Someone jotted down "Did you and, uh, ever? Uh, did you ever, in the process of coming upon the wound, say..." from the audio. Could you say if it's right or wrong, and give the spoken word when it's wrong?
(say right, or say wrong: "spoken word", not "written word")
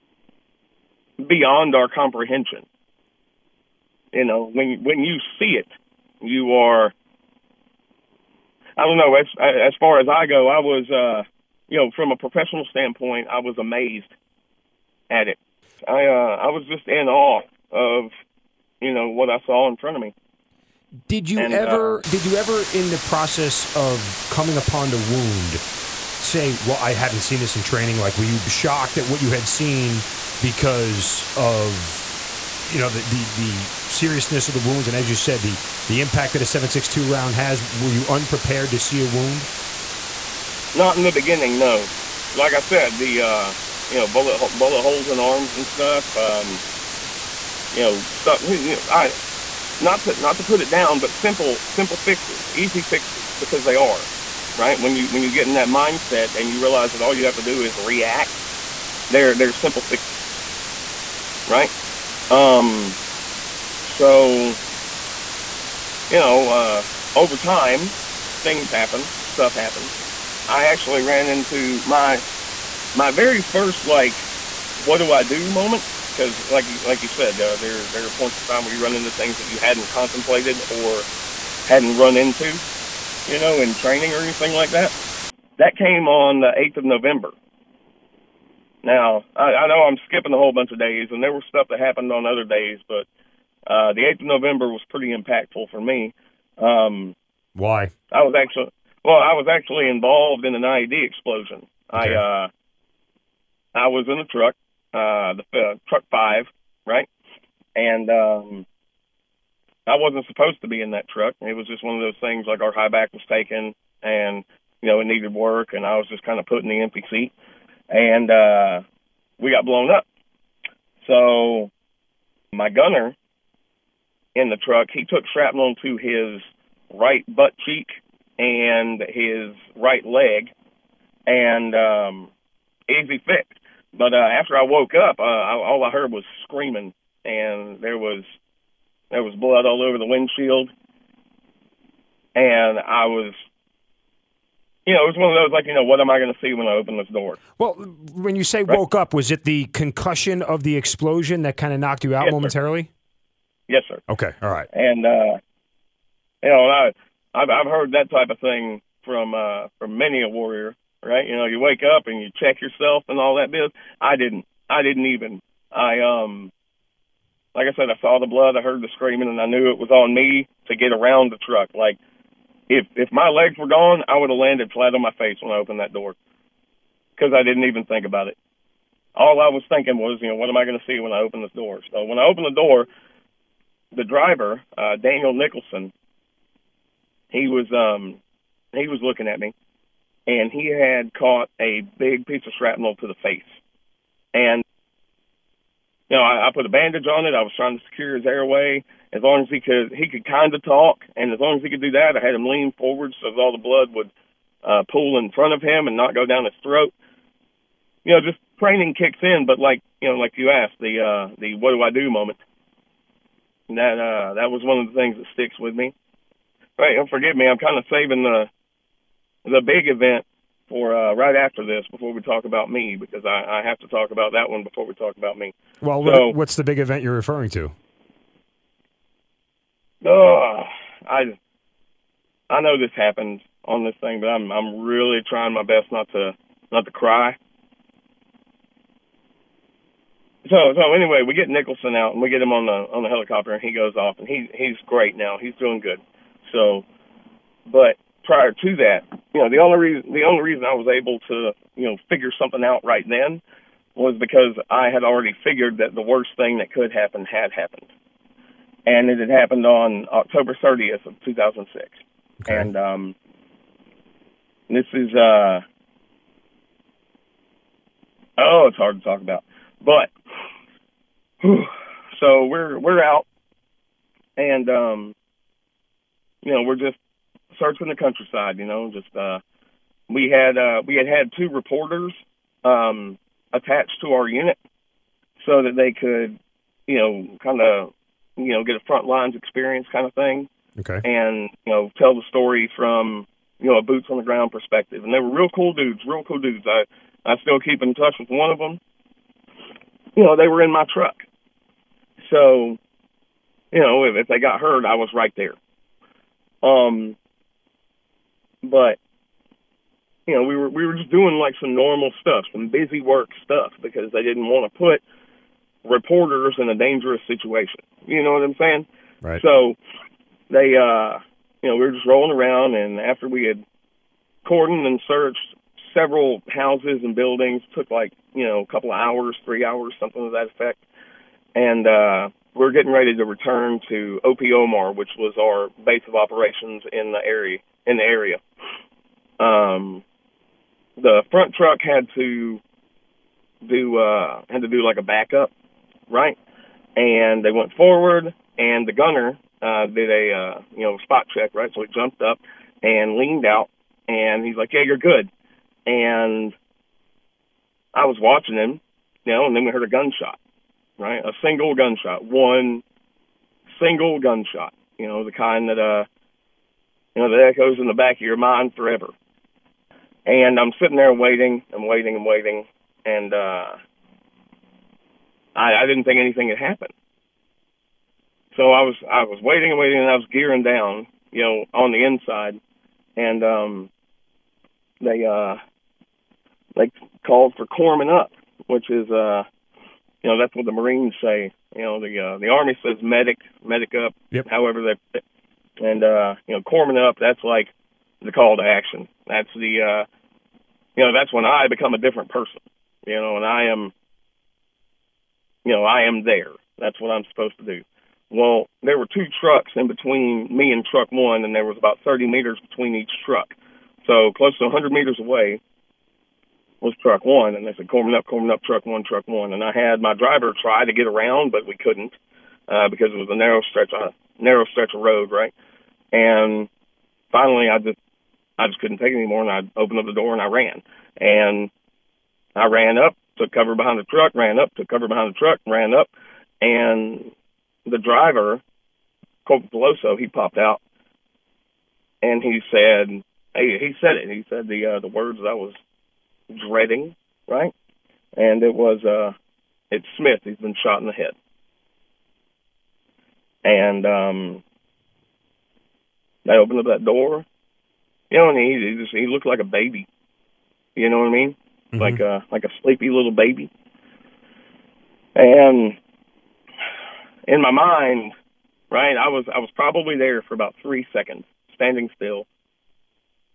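right.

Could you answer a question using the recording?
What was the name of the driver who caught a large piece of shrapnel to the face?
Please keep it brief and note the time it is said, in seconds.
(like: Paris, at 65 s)
Daniel Nicholson, at 185 s.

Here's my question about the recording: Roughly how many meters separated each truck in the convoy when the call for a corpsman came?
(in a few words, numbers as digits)
30.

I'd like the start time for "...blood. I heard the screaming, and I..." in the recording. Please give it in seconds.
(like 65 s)
168 s.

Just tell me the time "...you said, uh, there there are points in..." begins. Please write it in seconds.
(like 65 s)
77 s.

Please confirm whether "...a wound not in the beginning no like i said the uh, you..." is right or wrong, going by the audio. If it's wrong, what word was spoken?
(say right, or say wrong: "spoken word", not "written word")
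right.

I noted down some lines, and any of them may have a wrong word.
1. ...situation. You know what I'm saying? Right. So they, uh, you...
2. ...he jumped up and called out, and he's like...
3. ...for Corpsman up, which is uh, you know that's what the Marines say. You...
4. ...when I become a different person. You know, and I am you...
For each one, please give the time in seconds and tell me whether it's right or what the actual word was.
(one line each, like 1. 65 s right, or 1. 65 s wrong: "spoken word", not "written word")
1. 317 s right
2. 351 s wrong: "leaned", not "called"
3. 387 s right
4. 401 s right.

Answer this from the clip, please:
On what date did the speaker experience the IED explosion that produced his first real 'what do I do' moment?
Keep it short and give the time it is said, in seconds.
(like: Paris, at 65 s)
8th of November, at 85 s.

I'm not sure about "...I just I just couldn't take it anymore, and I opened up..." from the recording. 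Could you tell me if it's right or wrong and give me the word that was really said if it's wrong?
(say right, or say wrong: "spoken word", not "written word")
right.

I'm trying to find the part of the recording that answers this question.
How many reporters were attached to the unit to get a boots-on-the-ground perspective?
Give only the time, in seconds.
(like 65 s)
281 s.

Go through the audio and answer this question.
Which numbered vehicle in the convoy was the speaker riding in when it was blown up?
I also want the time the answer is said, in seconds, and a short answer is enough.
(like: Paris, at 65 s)
Truck five, at 105 s.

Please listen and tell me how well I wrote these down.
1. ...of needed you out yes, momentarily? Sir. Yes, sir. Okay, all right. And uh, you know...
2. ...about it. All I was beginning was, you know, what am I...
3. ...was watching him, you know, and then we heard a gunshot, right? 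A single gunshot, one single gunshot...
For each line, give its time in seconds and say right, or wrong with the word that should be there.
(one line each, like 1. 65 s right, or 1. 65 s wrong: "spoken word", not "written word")
1. 151 s wrong: "knocked", not "needed"
2. 178 s wrong: "thinking", not "beginning"
3. 358 s right.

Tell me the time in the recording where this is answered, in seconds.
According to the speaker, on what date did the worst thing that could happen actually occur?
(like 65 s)
260 s.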